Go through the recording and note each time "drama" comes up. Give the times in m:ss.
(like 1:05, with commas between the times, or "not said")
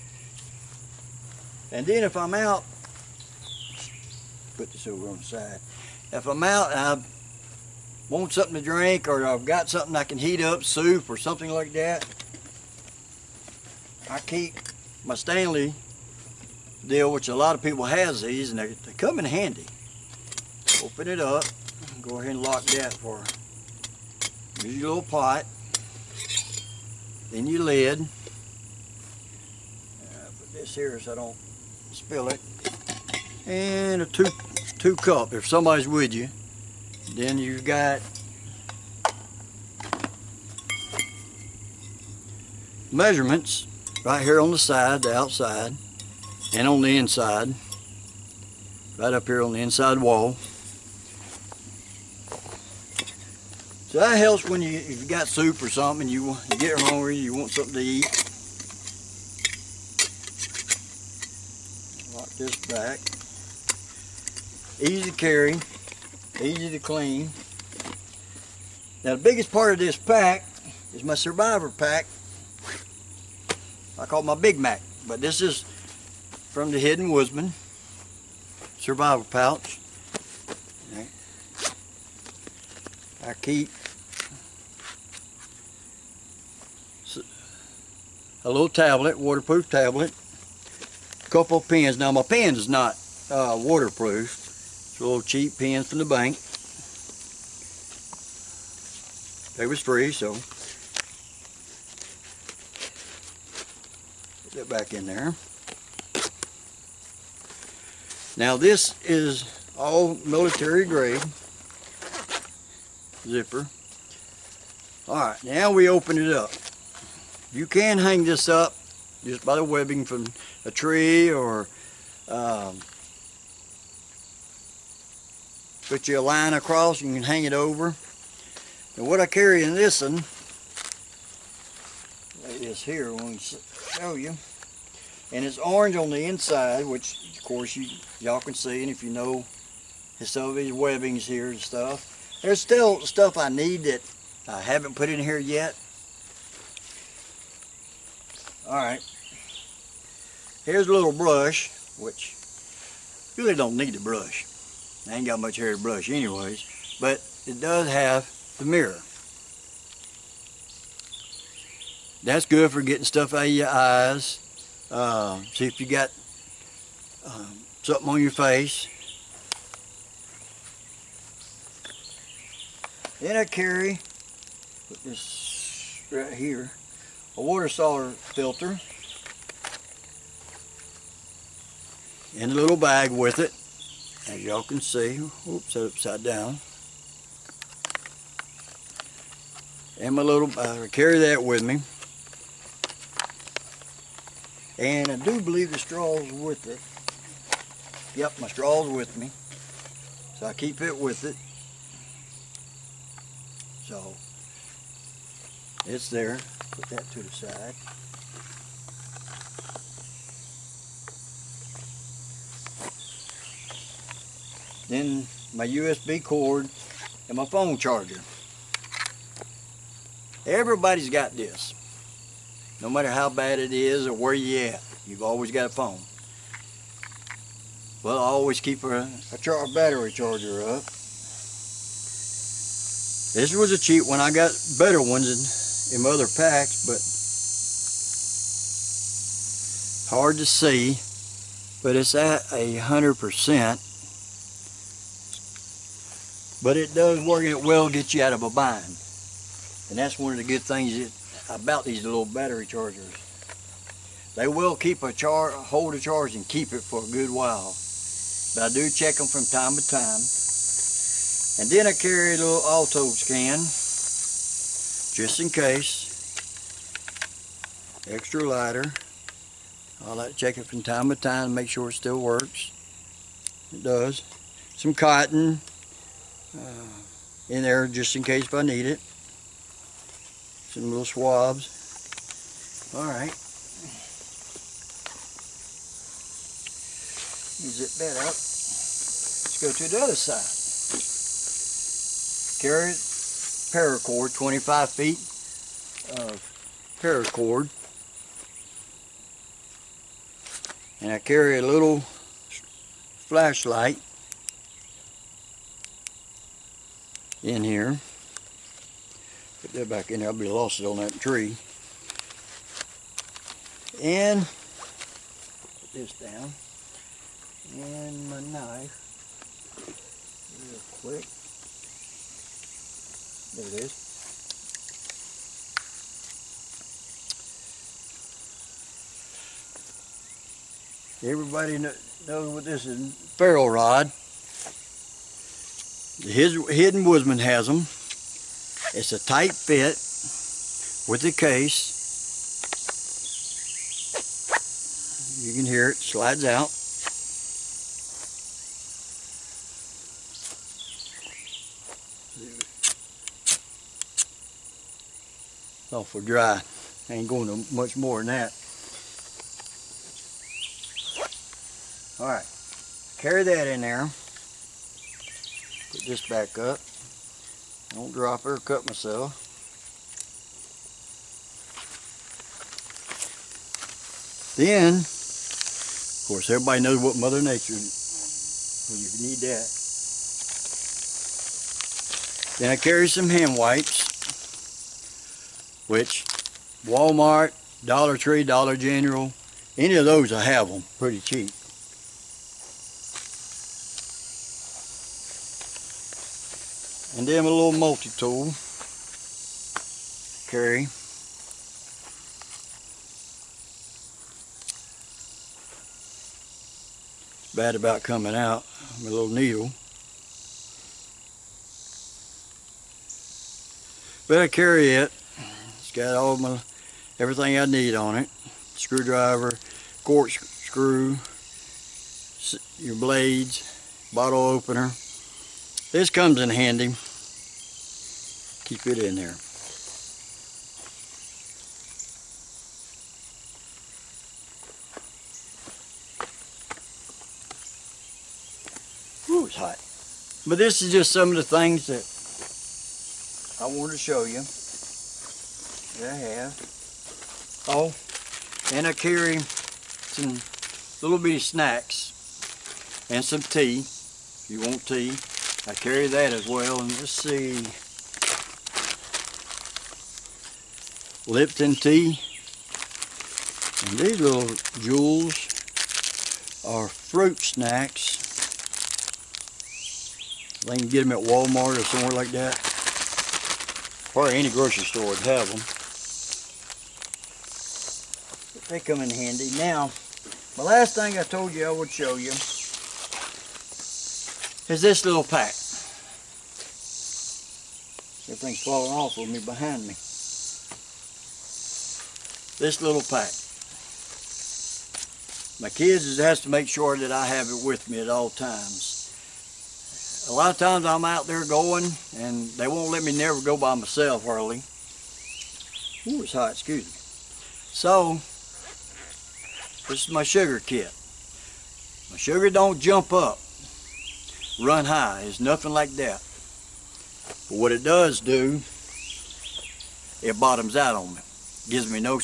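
not said.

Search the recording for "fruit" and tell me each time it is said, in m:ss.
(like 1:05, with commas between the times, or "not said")
7:46.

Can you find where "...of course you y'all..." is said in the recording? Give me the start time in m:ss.
2:17.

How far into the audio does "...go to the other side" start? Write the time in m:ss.
4:49.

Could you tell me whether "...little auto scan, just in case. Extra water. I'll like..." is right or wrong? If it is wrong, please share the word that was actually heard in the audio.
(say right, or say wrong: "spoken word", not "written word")
wrong: "lighter", not "water".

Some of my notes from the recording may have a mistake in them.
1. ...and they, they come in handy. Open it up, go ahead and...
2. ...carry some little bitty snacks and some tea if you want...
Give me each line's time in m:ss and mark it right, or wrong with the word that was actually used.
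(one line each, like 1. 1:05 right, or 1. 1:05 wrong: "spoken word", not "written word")
1. 0:18 right
2. 7:28 right.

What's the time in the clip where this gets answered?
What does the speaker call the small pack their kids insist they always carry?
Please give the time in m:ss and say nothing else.
8:30.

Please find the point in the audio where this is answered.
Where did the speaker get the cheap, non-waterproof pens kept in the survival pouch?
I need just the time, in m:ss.
1:35.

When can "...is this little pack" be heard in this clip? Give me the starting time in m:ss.
8:04.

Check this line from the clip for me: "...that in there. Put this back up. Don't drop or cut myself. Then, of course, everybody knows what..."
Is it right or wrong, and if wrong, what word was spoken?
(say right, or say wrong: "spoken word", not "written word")
right.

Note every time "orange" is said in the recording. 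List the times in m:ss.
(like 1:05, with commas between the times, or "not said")
2:15.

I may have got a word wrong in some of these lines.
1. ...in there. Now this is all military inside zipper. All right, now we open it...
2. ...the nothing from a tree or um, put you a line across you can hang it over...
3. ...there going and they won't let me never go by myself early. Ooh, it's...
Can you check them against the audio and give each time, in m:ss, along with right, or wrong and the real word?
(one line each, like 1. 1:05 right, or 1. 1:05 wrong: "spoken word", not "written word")
1. 1:44 wrong: "grade", not "inside"
2. 1:59 wrong: "webbing", not "nothing"
3. 8:21 right.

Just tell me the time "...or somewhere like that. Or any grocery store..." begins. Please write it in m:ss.
7:51.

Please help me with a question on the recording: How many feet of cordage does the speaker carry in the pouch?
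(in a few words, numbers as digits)
25.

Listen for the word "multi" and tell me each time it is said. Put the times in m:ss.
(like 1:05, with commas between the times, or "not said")
6:37.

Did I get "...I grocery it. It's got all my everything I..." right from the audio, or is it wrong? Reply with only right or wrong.
wrong.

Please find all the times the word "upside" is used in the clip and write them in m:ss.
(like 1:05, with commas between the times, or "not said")
3:05.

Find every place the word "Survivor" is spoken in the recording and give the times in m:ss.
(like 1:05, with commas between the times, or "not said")
1:11, 1:18.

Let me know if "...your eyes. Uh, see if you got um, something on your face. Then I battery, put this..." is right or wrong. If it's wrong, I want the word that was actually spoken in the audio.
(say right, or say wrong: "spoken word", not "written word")
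wrong: "carry", not "battery".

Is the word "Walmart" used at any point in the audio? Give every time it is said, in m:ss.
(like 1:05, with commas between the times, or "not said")
6:26, 7:51.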